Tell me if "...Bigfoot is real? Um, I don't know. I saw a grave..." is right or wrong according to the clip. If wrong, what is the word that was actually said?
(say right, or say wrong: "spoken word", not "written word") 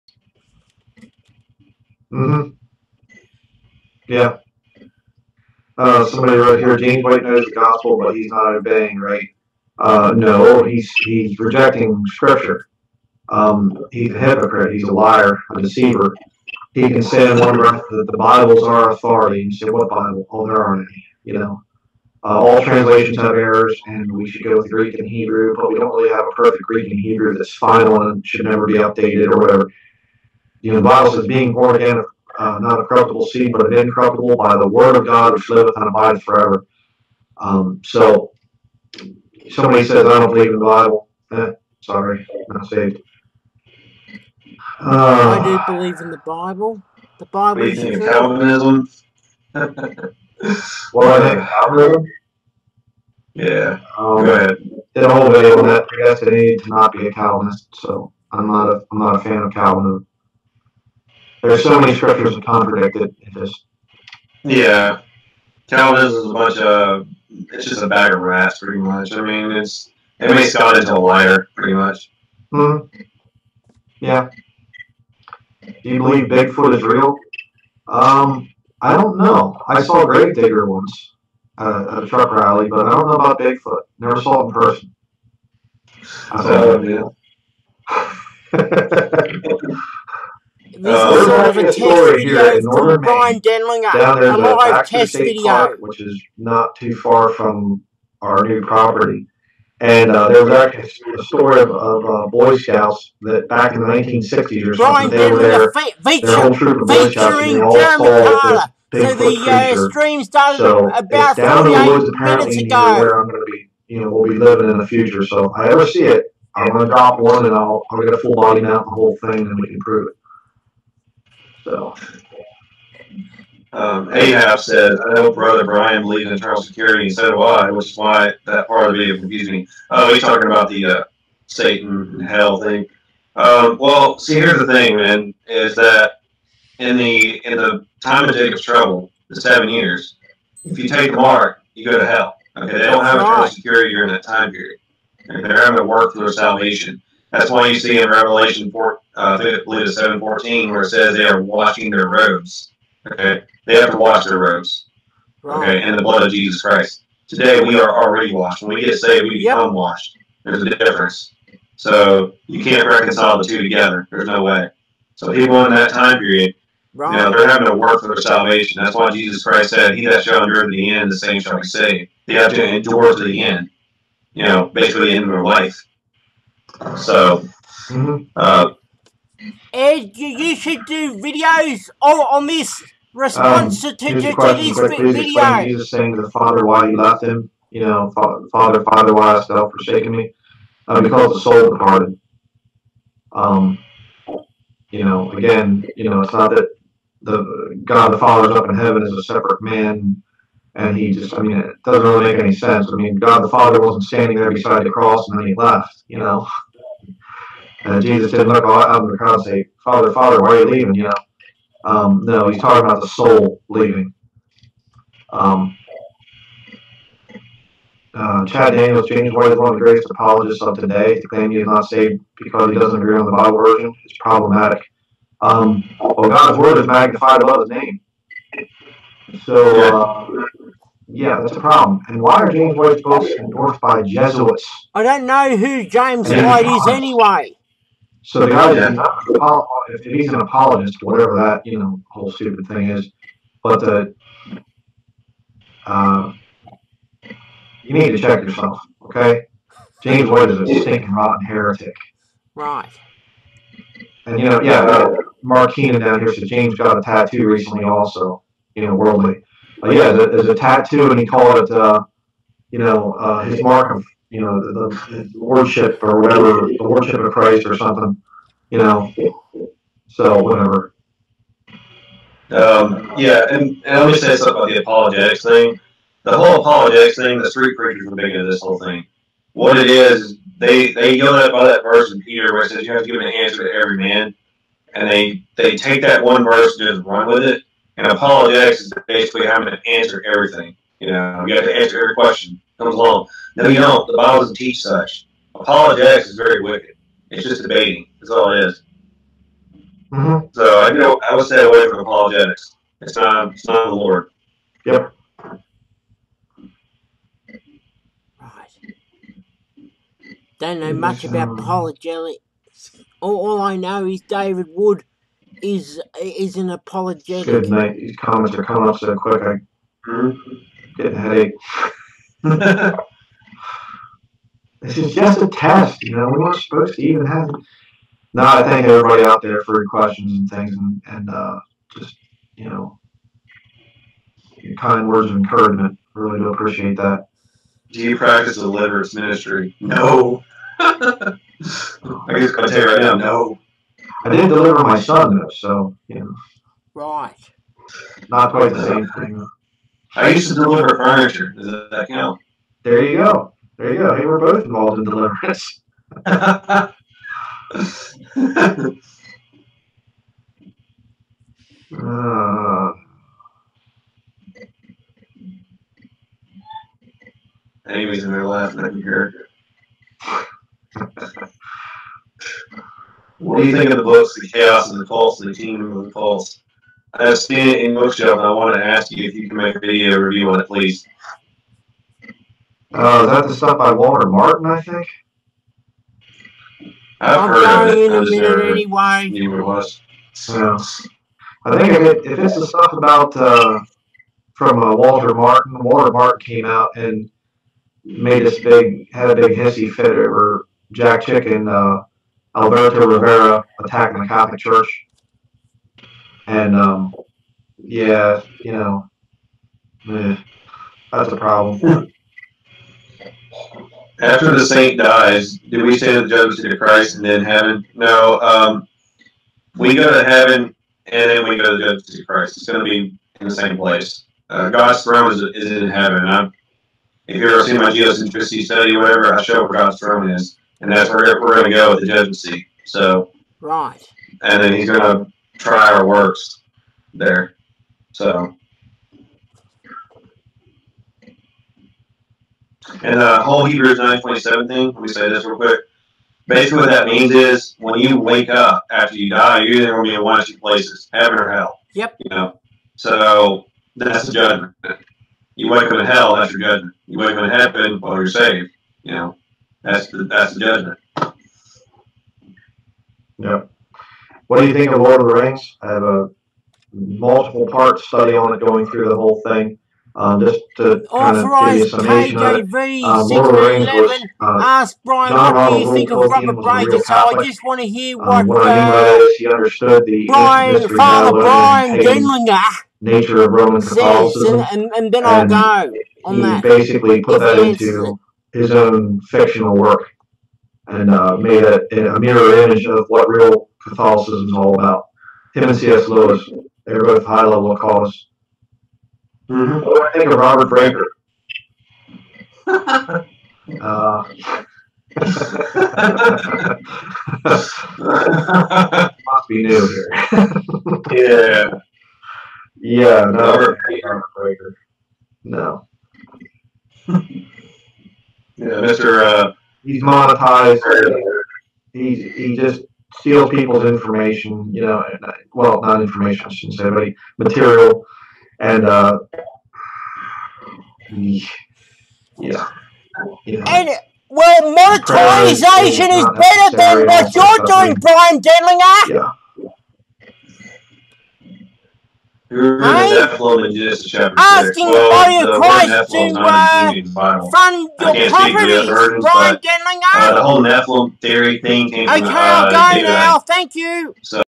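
right.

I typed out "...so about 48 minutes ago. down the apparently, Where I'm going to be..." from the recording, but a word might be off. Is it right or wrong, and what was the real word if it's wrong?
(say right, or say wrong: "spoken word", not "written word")
right.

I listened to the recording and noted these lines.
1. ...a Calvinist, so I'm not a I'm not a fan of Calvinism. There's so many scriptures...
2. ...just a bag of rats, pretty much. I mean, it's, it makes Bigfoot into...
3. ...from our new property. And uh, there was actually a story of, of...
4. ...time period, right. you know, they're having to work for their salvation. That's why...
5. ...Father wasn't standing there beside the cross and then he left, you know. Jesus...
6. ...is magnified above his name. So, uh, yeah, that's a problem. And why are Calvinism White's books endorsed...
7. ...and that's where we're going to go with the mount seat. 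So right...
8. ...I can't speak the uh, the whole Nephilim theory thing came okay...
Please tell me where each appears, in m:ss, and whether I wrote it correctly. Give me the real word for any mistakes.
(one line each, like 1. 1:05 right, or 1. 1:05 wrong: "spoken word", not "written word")
1. 0:57 right
2. 1:07 wrong: "God", not "Bigfoot"
3. 1:37 right
4. 2:45 right
5. 3:23 right
6. 3:46 wrong: "James", not "Calvinism"
7. 7:10 wrong: "judgment", not "mount"
8. 9:07 right.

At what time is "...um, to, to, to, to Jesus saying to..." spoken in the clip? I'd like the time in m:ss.
3:03.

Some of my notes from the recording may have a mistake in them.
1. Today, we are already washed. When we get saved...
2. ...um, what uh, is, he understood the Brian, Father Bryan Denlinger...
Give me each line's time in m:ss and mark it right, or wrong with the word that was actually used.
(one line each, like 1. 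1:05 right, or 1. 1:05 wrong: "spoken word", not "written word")
1. 2:37 right
2. 7:58 right.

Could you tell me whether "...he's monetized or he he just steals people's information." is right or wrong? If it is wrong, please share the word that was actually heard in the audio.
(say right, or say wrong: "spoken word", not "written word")
right.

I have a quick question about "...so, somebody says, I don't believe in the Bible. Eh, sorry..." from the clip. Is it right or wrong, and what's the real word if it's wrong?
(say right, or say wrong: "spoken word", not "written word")
right.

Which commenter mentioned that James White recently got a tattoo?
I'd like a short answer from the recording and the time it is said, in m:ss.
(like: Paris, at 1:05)
Mark Keenan, at 4:15.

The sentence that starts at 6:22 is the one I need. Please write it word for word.
Uh, is that the stuff by Walter Martin, I think?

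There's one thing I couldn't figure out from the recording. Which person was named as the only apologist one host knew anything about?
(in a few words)
David Wood.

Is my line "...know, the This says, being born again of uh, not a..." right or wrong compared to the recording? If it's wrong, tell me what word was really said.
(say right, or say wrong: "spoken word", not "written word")
wrong: "Bible", not "This".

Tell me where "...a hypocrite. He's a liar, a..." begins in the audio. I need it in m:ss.
0:14.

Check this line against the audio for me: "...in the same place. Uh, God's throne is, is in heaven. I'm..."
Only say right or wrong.
right.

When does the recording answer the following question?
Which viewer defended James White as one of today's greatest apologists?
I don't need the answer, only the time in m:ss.
3:38.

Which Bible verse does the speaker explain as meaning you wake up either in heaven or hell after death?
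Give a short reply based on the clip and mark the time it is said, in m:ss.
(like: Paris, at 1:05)
Hebrews 9:27, at 7:23.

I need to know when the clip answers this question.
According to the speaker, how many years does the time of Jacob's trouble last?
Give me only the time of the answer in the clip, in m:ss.
2:19.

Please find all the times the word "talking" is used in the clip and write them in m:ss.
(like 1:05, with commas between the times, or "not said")
2:10, 3:32.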